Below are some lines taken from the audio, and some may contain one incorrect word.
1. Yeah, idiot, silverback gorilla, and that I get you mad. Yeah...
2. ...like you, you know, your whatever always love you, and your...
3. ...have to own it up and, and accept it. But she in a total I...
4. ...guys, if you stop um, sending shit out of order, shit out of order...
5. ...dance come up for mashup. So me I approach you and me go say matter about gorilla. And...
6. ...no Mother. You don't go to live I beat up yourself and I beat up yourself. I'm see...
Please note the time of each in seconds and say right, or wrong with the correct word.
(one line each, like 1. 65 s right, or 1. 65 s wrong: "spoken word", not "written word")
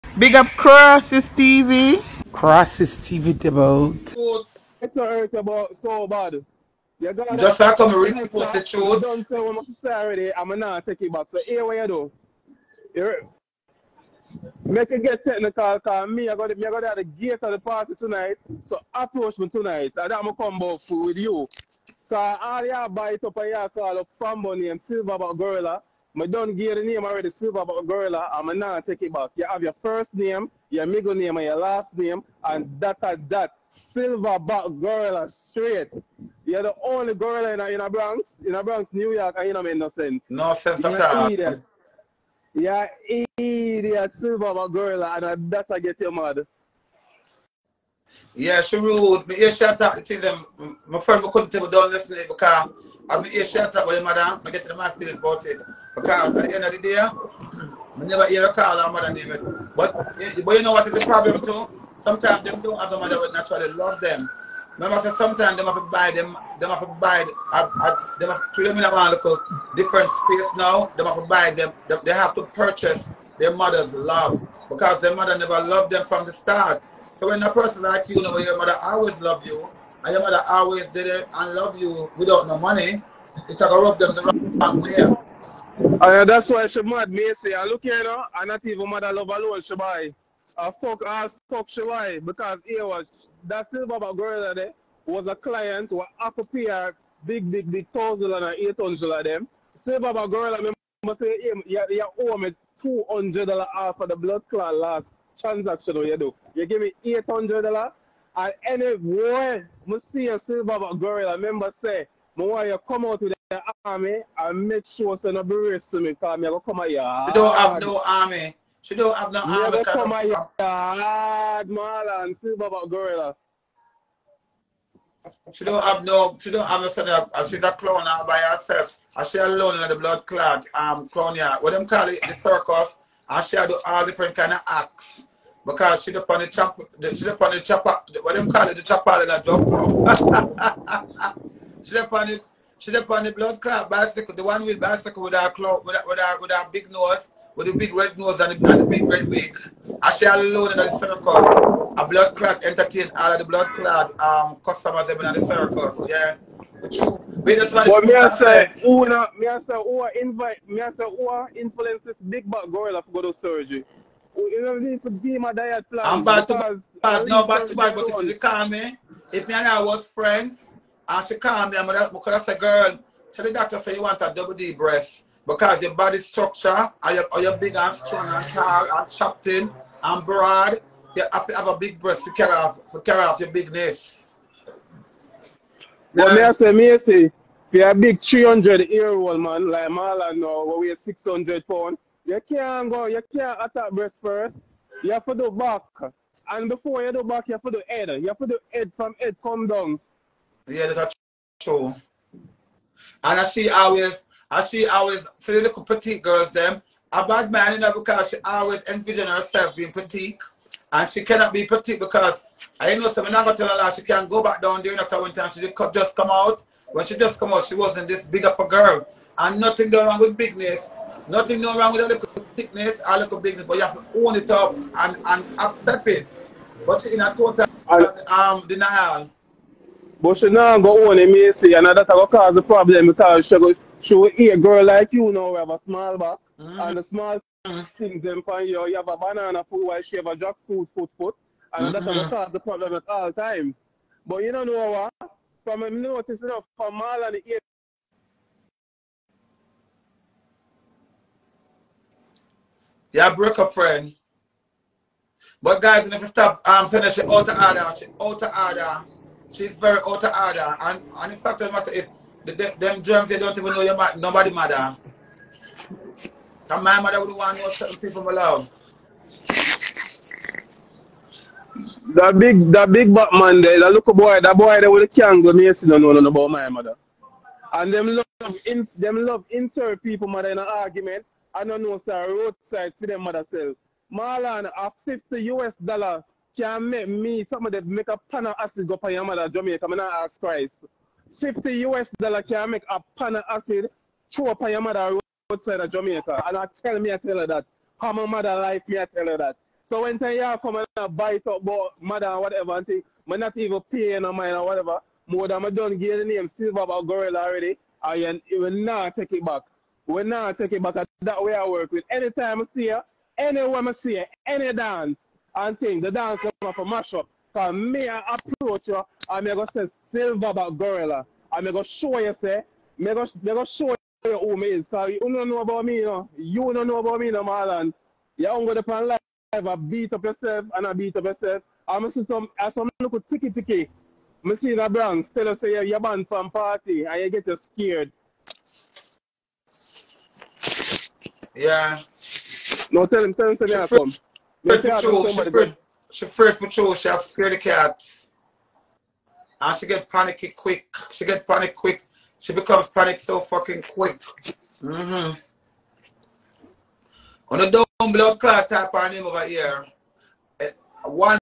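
1. 42 s right
2. 77 s wrong: "mother", not "whatever"
3. 223 s right
4. 255 s right
5. 316 s wrong: "silver", not "matter"
6. 327 s wrong: "Marlon", not "Mother".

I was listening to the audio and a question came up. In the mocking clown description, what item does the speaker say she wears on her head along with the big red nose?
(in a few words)
big red wig.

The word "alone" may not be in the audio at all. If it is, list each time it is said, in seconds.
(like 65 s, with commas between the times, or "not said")
89 s, 129 s, 150 s.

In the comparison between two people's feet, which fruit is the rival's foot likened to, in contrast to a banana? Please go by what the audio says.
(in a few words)
jackfruit.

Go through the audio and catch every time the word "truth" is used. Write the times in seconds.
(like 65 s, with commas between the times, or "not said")
8 s.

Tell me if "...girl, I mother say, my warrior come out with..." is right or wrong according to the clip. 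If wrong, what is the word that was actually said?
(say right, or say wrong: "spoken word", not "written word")
wrong: "remember", not "mother".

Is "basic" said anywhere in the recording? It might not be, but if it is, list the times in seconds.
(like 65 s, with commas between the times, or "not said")
not said.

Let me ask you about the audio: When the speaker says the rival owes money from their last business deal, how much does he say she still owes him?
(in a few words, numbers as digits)
$200.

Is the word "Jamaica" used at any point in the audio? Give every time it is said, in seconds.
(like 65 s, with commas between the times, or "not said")
289 s, 295 s.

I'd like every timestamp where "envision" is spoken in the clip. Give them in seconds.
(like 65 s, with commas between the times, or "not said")
208 s.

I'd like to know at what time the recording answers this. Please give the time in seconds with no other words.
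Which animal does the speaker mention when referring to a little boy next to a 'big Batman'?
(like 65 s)
275 s.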